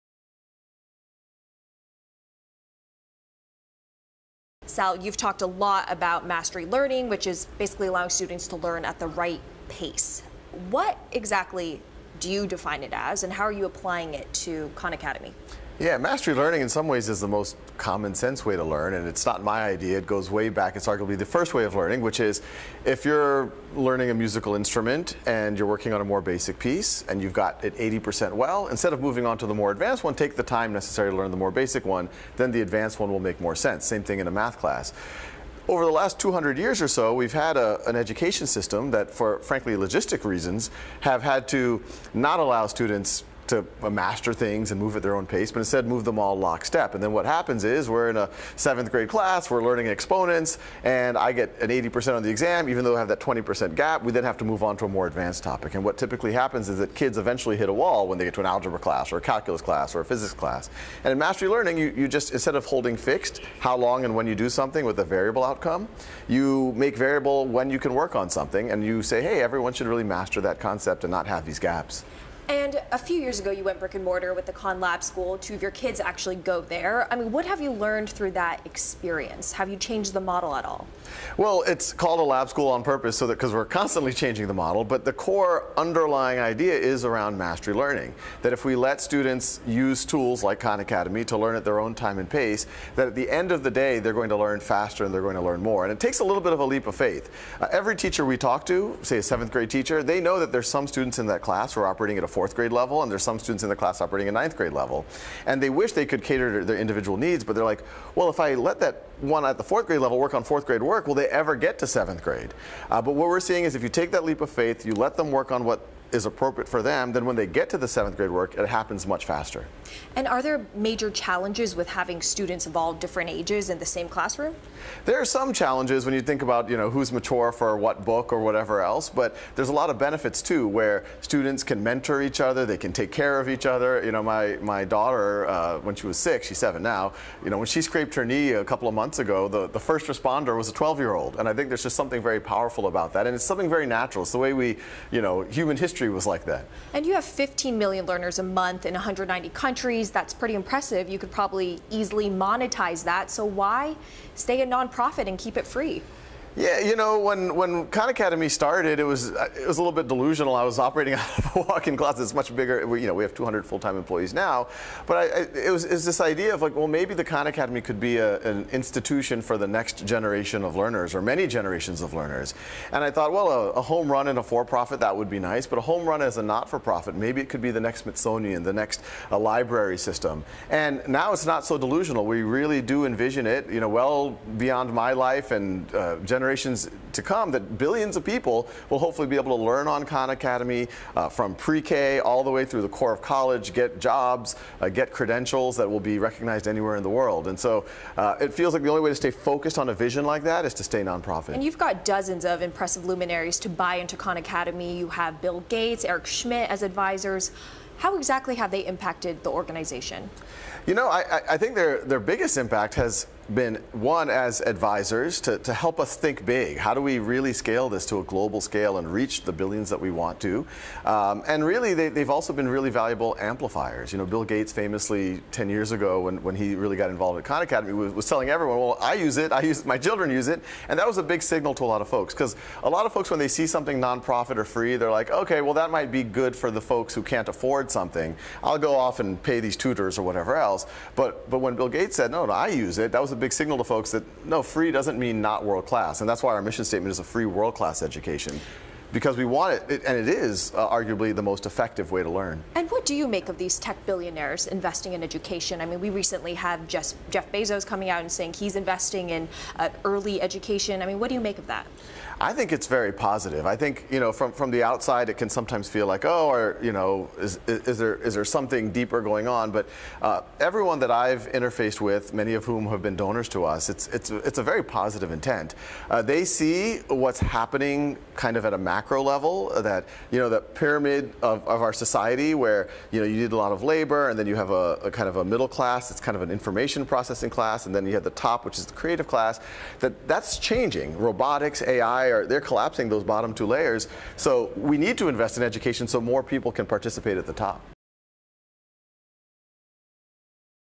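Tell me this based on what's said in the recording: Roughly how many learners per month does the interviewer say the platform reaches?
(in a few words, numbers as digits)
15 million.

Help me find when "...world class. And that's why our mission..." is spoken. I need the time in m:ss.
4:05.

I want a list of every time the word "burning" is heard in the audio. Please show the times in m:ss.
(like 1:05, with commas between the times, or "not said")
not said.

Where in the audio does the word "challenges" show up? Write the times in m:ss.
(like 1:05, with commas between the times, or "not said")
2:01, 2:05.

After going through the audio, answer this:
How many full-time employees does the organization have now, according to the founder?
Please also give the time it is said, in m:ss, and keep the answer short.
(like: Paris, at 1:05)
200, at 2:43.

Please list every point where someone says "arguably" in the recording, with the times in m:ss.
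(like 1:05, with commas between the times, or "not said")
0:20, 4:10.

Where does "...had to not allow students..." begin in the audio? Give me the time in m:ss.
0:41.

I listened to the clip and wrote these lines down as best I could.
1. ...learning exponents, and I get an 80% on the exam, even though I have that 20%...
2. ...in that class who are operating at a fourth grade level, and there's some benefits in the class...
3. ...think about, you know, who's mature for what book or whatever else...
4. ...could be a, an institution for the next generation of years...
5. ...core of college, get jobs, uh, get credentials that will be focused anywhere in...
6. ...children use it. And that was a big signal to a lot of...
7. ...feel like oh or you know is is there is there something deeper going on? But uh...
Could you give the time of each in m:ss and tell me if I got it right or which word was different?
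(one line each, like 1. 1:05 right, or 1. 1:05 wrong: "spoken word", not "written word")
1. 0:49 right
2. 1:41 wrong: "students", not "benefits"
3. 2:06 right
4. 2:47 wrong: "learners", not "years"
5. 3:12 wrong: "recognized", not "focused"
6. 3:49 right
7. 4:25 right.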